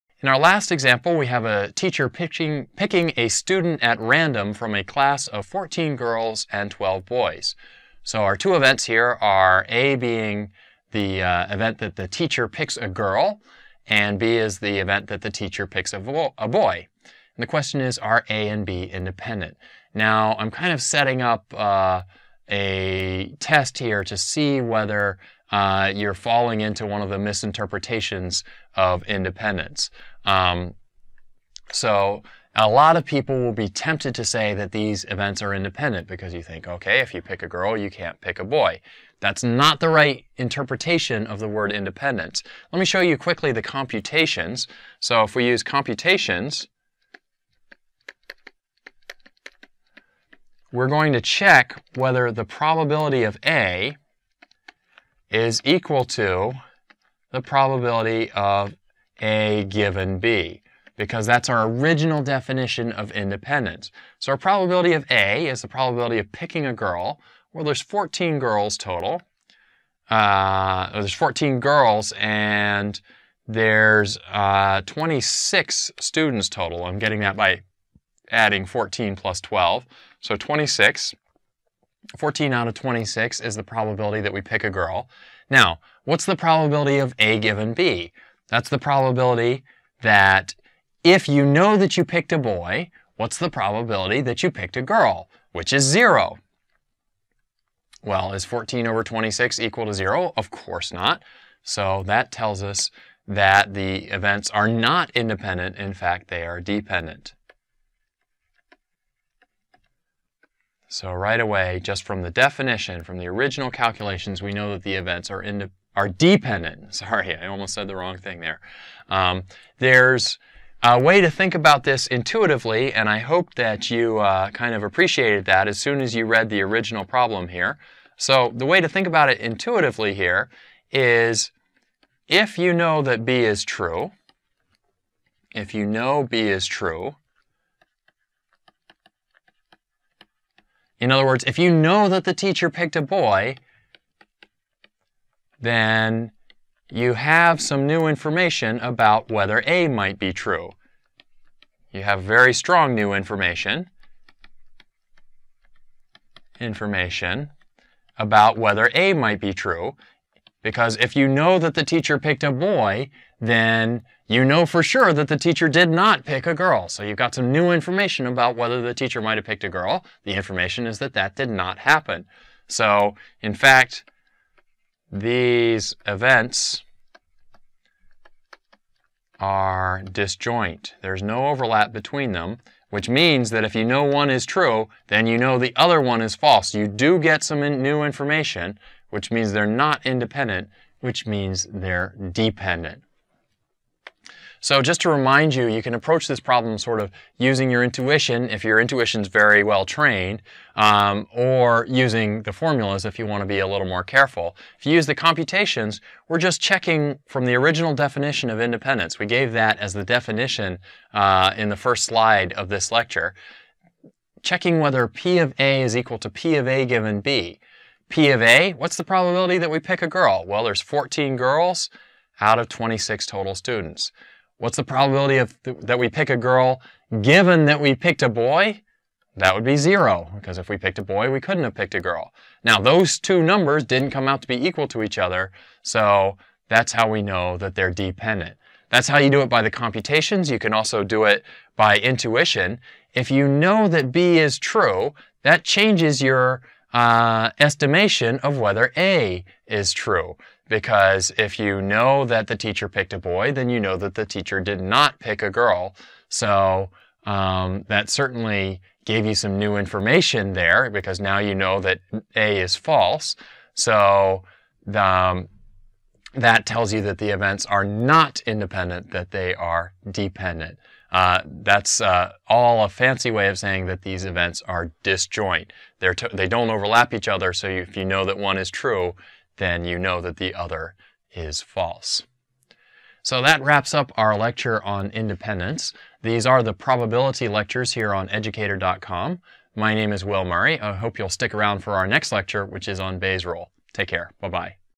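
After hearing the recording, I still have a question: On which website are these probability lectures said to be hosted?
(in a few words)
educator.com.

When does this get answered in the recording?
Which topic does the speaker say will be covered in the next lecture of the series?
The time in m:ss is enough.
4:53.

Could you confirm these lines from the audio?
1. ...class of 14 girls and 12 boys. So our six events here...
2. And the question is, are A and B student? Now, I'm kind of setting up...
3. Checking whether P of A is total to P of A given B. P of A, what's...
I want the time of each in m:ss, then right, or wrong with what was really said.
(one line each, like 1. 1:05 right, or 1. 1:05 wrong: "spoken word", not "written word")
1. 0:04 wrong: "two", not "six"
2. 0:17 wrong: "independent", not "student"
3. 3:34 wrong: "equal", not "total".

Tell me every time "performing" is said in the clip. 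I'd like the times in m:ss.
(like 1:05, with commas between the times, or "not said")
not said.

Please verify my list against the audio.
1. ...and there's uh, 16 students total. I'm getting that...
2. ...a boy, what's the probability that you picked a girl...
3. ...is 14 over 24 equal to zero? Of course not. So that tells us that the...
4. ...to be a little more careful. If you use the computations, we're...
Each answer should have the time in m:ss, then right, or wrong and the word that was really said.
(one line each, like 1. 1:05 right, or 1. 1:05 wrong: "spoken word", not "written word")
1. 1:12 wrong: "26", not "16"
2. 1:32 right
3. 1:38 wrong: "26", not "24"
4. 3:23 right.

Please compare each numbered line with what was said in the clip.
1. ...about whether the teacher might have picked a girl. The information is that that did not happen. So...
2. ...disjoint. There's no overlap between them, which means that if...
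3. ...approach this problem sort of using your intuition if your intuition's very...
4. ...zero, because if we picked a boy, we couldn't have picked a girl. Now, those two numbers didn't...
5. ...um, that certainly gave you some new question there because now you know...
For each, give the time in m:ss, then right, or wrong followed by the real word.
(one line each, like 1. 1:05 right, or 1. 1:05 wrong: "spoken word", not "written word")
1. 2:48 right
2. 3:00 right
3. 3:15 right
4. 3:49 right
5. 4:17 wrong: "information", not "question".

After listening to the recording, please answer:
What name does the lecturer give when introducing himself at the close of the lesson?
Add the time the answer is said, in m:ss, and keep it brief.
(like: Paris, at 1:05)
Will Murray, at 4:50.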